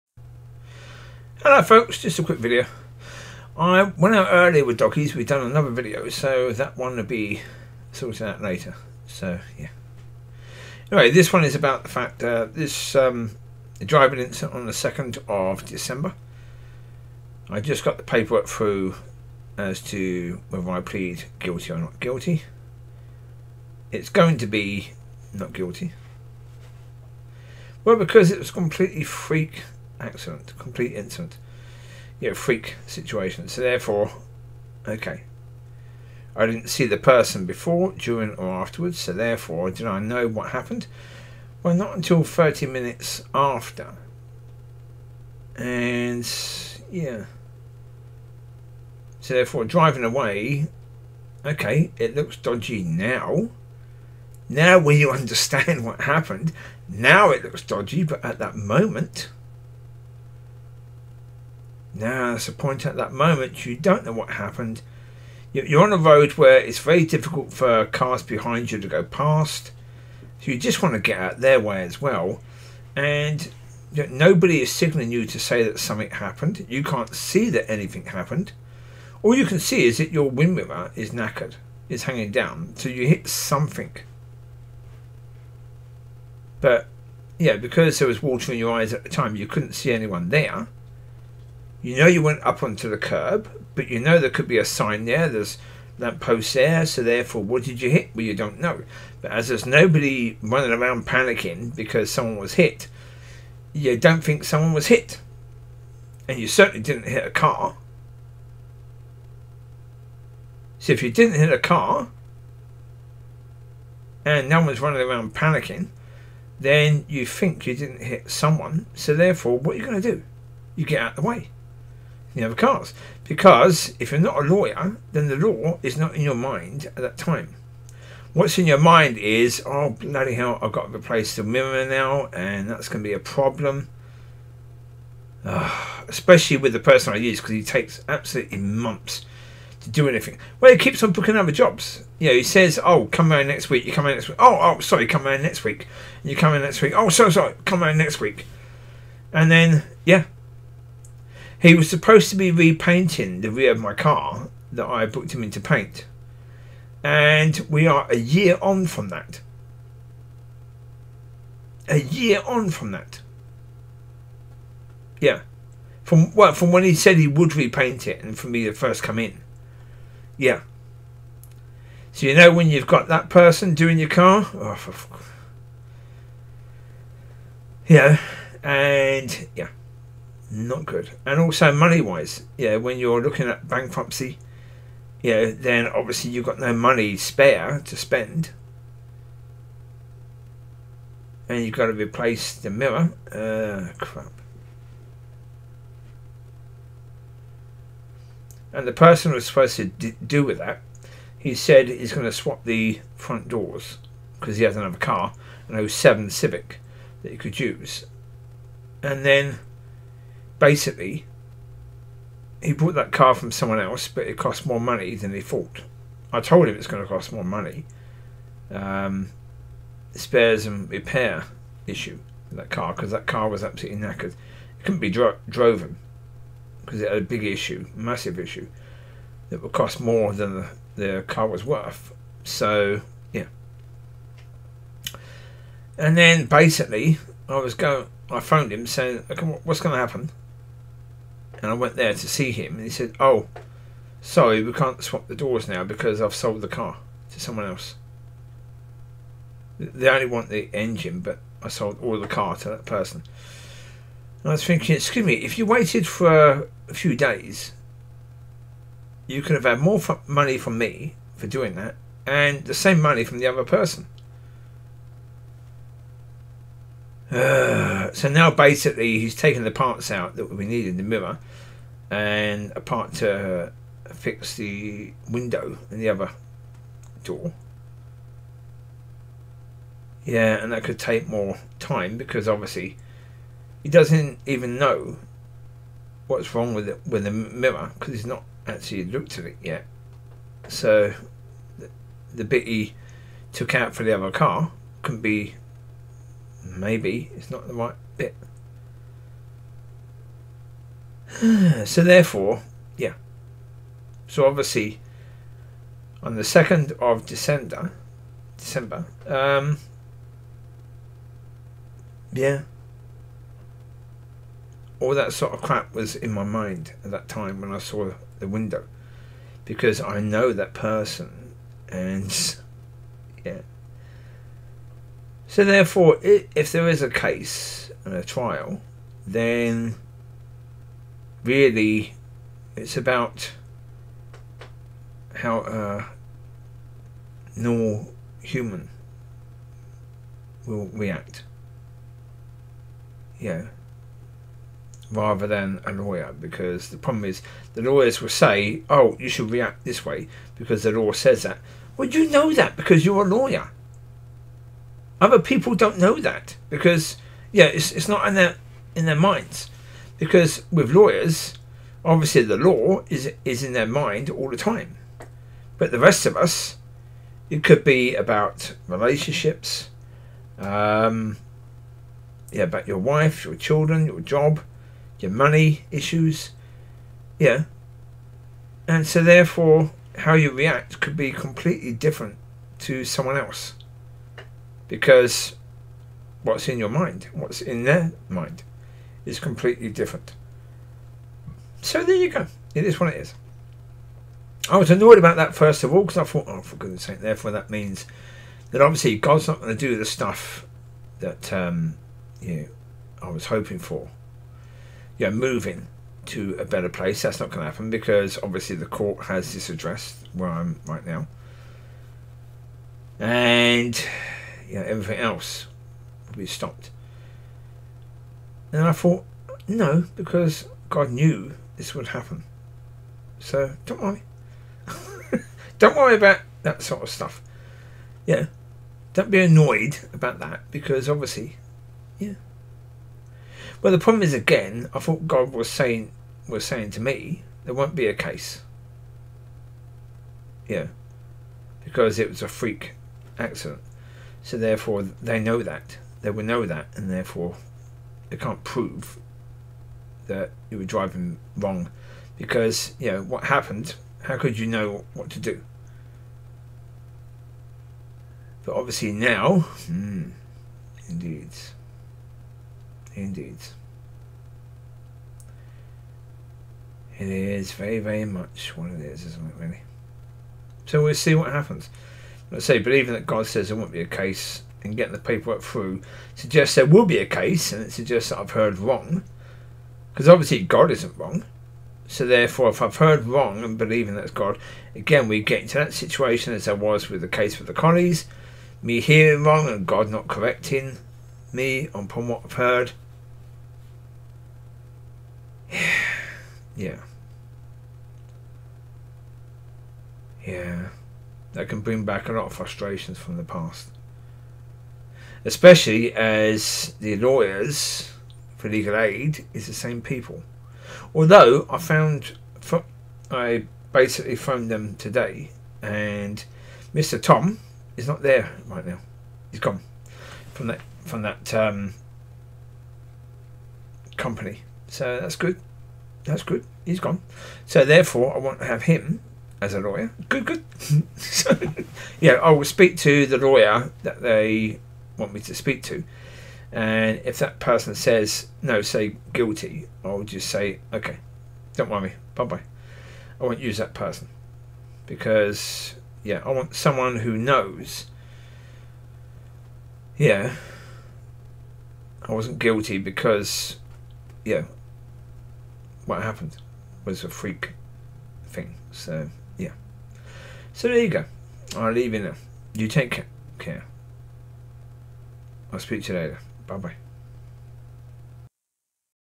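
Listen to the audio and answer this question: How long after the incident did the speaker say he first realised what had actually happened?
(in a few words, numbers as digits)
30 minutes.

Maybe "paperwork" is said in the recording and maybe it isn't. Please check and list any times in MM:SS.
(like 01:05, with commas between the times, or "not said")
00:18, 07:55.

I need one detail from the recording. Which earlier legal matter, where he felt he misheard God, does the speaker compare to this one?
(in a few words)
the case with the Connies.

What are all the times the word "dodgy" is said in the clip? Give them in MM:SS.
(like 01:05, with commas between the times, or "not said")
00:52, 00:57.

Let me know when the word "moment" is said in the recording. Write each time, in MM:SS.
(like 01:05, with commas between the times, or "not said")
00:58, 01:03.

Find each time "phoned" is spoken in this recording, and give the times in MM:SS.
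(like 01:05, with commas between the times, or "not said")
03:58, 08:34.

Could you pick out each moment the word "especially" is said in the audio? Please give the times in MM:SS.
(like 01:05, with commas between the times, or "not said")
02:16, 08:25.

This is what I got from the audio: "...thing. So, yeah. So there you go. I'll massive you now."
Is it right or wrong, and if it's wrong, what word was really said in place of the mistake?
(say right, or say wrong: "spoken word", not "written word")
wrong: "leave", not "massive".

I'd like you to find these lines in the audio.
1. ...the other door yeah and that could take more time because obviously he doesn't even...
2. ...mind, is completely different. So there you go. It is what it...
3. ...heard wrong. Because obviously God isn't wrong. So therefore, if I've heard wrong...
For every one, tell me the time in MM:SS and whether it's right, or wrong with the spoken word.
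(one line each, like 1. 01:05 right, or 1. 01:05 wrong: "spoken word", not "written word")
1. 04:36 right
2. 06:28 right
3. 07:58 right.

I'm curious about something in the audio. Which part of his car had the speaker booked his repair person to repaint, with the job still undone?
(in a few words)
the rear.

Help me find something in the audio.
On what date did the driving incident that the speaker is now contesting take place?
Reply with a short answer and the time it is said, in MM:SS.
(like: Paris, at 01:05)
2nd of December, at 00:14.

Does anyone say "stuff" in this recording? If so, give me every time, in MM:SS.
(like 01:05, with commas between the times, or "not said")
06:40, 07:07.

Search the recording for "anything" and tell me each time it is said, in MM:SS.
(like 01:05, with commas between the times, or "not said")
01:17, 02:20.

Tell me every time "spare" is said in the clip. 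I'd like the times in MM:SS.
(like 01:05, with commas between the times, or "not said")
03:07, 03:40.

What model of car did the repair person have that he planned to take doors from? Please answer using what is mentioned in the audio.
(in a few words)
Civic.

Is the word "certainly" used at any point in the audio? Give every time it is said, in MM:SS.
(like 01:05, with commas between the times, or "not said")
01:46.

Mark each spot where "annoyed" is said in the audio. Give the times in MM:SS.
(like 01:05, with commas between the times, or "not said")
06:34, 07:09.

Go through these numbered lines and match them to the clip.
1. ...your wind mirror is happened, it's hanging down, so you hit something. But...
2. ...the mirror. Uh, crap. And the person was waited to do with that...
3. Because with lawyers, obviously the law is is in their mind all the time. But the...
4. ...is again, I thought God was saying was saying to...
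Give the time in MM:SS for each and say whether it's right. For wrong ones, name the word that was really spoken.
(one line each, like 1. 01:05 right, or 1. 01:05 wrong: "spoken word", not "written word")
1. 01:20 wrong: "knackered", not "happened"
2. 03:12 wrong: "supposed", not "waited"
3. 06:00 right
4. 07:14 right.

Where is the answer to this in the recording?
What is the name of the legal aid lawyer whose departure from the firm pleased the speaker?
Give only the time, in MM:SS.
08:36.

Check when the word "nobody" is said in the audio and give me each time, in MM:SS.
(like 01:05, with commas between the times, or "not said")
01:13, 01:39.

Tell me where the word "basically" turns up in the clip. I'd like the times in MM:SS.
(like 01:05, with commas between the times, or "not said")
03:30, 03:56, 04:28, 08:33.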